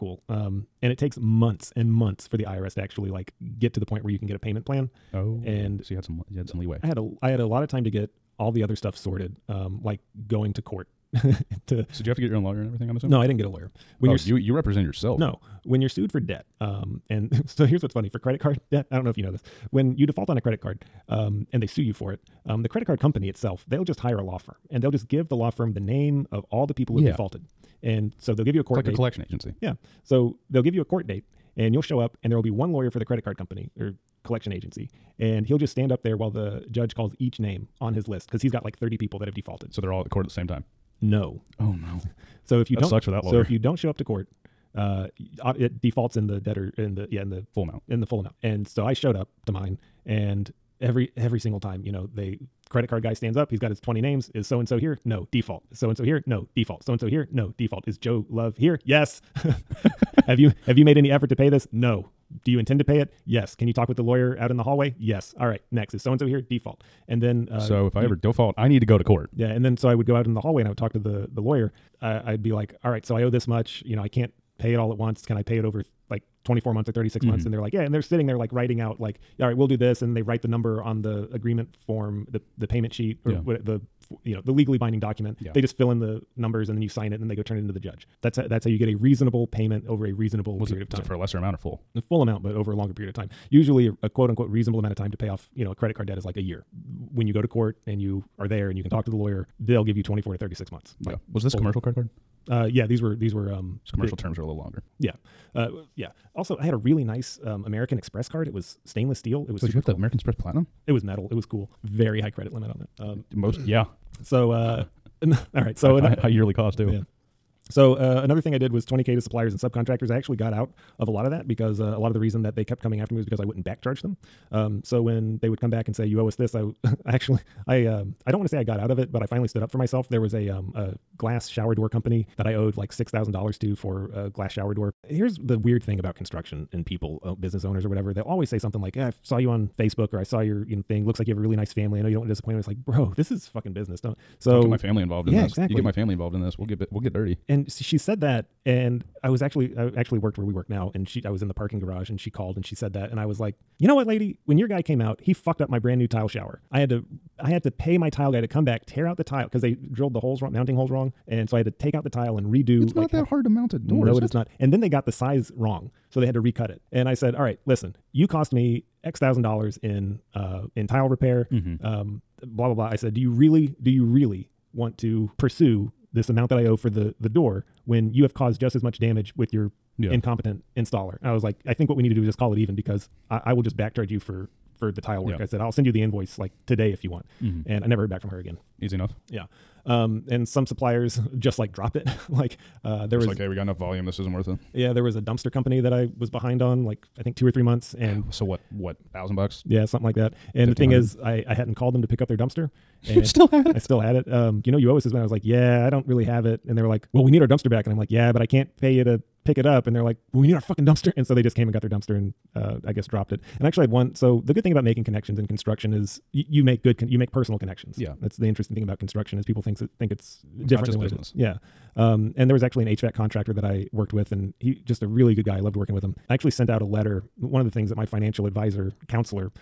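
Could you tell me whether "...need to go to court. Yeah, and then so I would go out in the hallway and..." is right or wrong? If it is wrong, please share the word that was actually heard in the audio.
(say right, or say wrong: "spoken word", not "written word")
right.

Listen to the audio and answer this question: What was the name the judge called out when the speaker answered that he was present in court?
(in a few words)
Joe Love.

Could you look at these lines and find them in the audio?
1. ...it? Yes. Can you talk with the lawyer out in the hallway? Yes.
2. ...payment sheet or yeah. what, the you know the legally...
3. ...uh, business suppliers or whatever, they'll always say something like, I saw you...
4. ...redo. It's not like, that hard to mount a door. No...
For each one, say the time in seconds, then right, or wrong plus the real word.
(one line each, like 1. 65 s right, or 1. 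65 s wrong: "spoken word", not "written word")
1. 62 s right
2. 82 s right
3. 137 s wrong: "owners", not "suppliers"
4. 162 s right.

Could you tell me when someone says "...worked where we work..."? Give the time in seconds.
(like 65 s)
150 s.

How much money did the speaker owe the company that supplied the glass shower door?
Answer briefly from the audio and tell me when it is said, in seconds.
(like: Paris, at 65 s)
$6,000, at 132 s.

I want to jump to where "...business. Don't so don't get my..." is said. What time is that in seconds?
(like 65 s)
143 s.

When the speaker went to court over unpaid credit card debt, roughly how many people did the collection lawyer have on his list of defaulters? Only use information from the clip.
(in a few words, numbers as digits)
30.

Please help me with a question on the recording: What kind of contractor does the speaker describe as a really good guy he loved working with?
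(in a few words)
HVAC contractor.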